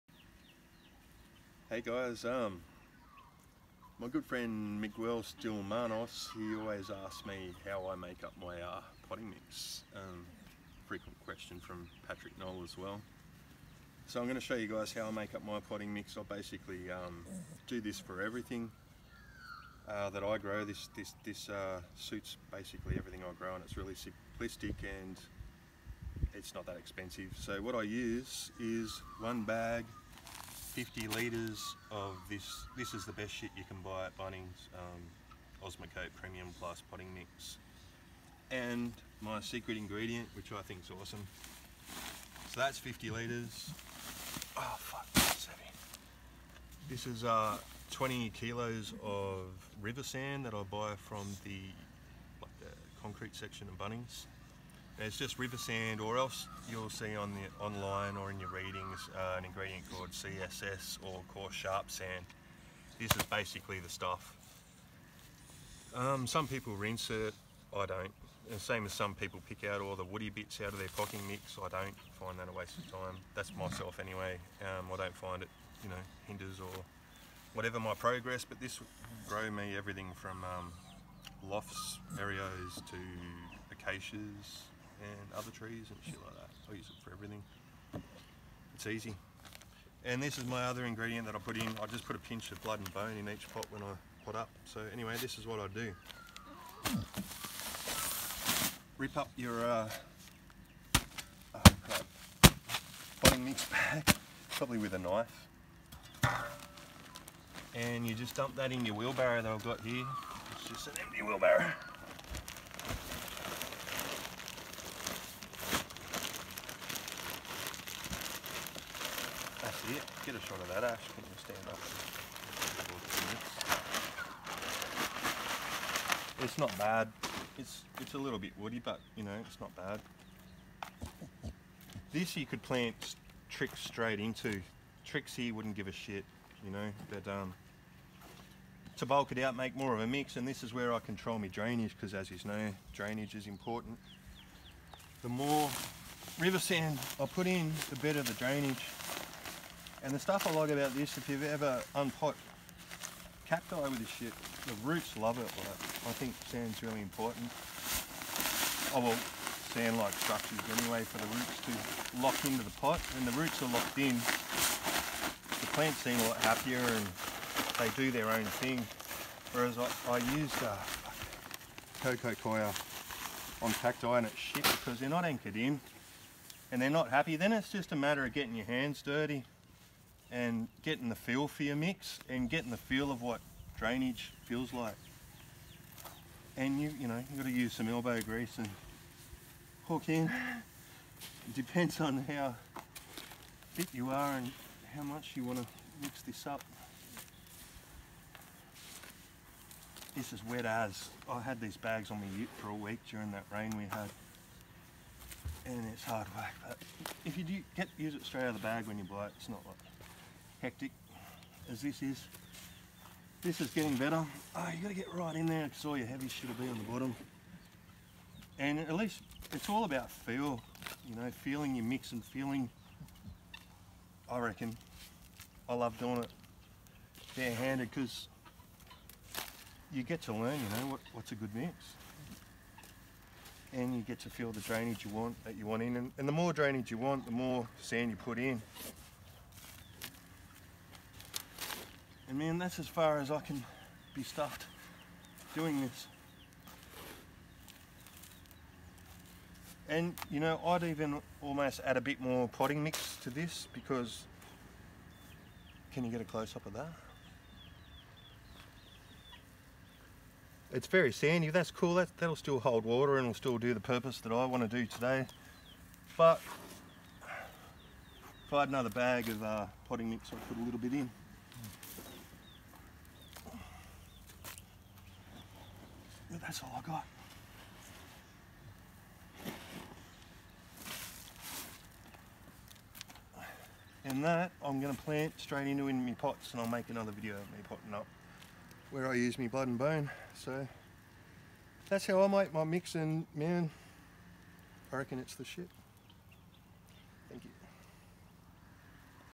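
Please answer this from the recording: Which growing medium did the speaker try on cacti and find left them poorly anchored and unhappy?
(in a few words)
coco coir.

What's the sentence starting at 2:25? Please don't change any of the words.
The more river sand I put in, the better the drainage.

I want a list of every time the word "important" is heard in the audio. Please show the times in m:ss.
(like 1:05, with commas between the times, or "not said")
2:23, 2:37.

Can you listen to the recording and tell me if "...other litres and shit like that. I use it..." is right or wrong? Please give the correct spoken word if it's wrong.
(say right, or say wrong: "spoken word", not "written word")
wrong: "trees", not "litres".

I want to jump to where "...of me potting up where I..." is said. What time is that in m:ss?
4:47.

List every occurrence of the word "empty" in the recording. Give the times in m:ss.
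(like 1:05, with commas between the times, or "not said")
1:51.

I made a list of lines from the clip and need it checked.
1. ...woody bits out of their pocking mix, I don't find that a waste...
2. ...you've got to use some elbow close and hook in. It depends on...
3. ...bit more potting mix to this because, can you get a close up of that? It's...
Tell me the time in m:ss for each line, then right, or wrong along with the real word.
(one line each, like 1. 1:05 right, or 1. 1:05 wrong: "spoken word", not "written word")
1. 1:10 right
2. 3:07 wrong: "grease", not "close"
3. 4:12 right.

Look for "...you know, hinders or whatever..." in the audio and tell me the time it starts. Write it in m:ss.
1:15.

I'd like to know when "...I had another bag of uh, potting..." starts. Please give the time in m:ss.
4:28.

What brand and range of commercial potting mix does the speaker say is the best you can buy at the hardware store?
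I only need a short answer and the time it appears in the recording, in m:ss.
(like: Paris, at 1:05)
Osmocote Premium Plus, at 0:35.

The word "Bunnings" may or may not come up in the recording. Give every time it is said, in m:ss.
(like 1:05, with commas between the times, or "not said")
0:34, 0:53.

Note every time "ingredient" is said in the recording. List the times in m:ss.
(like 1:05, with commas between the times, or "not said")
0:39, 0:59, 1:30.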